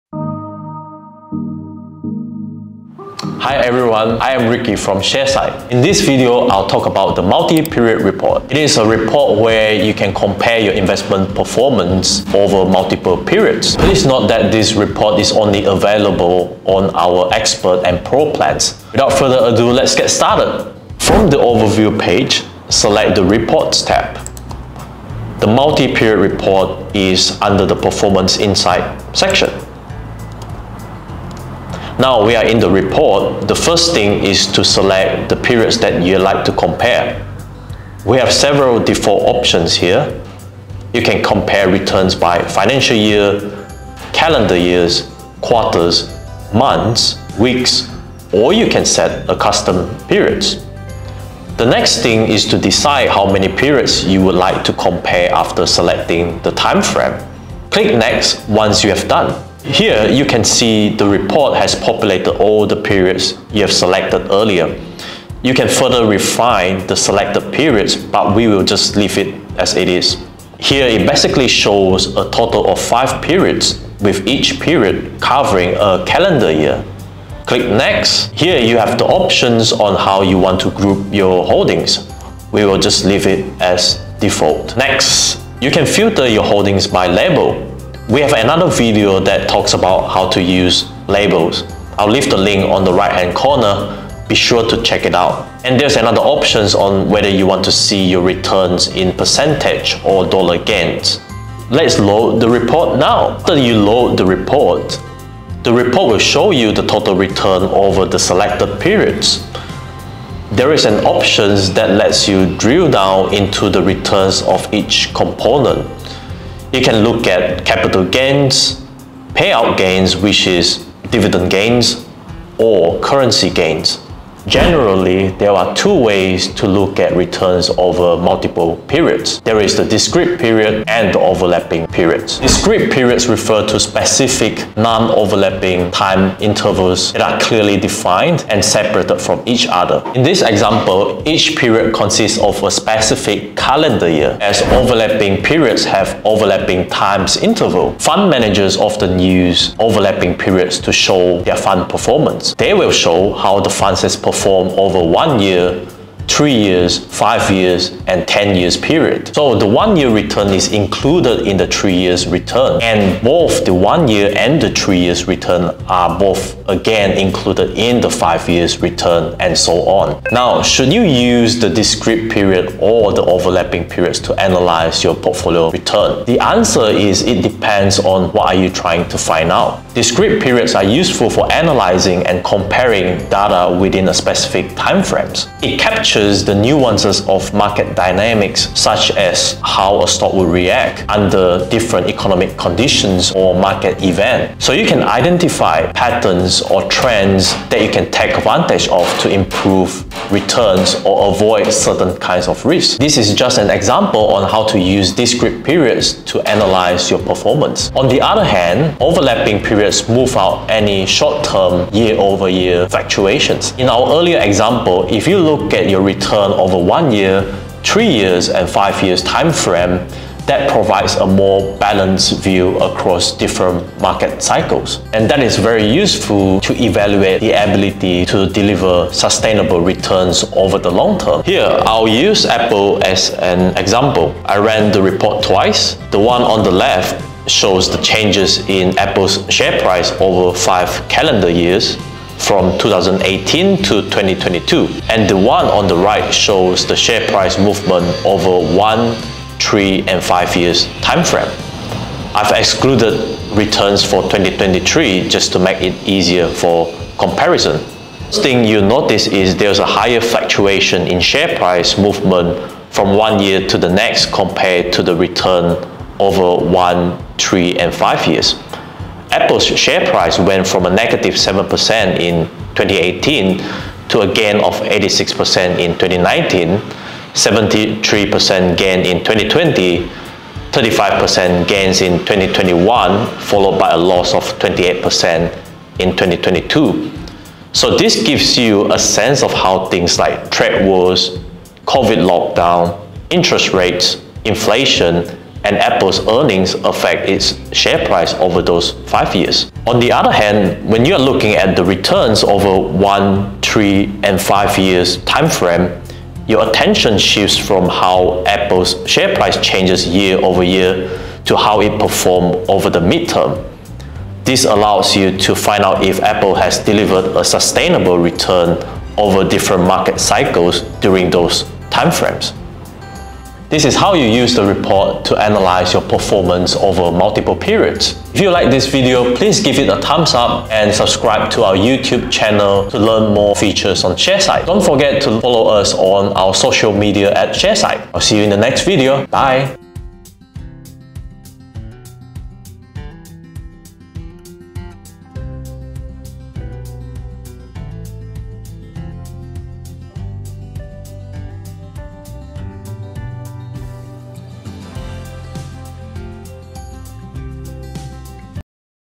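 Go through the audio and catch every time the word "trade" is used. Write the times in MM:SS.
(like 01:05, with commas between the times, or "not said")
04:50.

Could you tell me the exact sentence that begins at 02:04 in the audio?
Generally, there are two ways to look at returns over multiple periods.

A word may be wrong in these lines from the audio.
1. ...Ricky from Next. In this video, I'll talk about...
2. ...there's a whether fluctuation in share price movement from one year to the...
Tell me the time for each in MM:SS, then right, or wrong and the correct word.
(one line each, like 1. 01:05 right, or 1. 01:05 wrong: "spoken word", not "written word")
1. 00:04 wrong: "Sharesight", not "Next"
2. 04:19 wrong: "higher", not "whether".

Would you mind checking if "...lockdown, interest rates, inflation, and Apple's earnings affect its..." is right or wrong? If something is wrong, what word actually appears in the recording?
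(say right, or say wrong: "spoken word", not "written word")
right.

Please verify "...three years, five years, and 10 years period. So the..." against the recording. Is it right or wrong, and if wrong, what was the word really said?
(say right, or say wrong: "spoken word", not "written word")
right.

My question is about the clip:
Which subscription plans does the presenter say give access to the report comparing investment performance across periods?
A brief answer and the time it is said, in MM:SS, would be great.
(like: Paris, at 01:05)
Expert and Pro, at 00:17.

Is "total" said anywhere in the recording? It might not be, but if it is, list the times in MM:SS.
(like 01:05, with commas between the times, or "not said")
01:12, 01:46.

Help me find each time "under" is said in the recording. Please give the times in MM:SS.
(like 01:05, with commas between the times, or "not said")
00:27, 03:11.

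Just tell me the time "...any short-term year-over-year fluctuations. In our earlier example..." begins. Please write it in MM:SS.
03:30.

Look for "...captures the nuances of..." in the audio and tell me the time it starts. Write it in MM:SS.
03:06.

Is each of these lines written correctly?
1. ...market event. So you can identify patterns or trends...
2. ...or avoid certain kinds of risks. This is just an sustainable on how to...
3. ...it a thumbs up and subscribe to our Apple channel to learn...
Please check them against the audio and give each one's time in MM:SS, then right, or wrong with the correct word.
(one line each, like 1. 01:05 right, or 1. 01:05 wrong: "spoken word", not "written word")
1. 03:13 right
2. 03:21 wrong: "example", not "sustainable"
3. 05:29 wrong: "YouTube", not "Apple".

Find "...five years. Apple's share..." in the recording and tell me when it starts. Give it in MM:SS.
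04:27.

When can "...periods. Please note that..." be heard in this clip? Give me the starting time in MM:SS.
00:13.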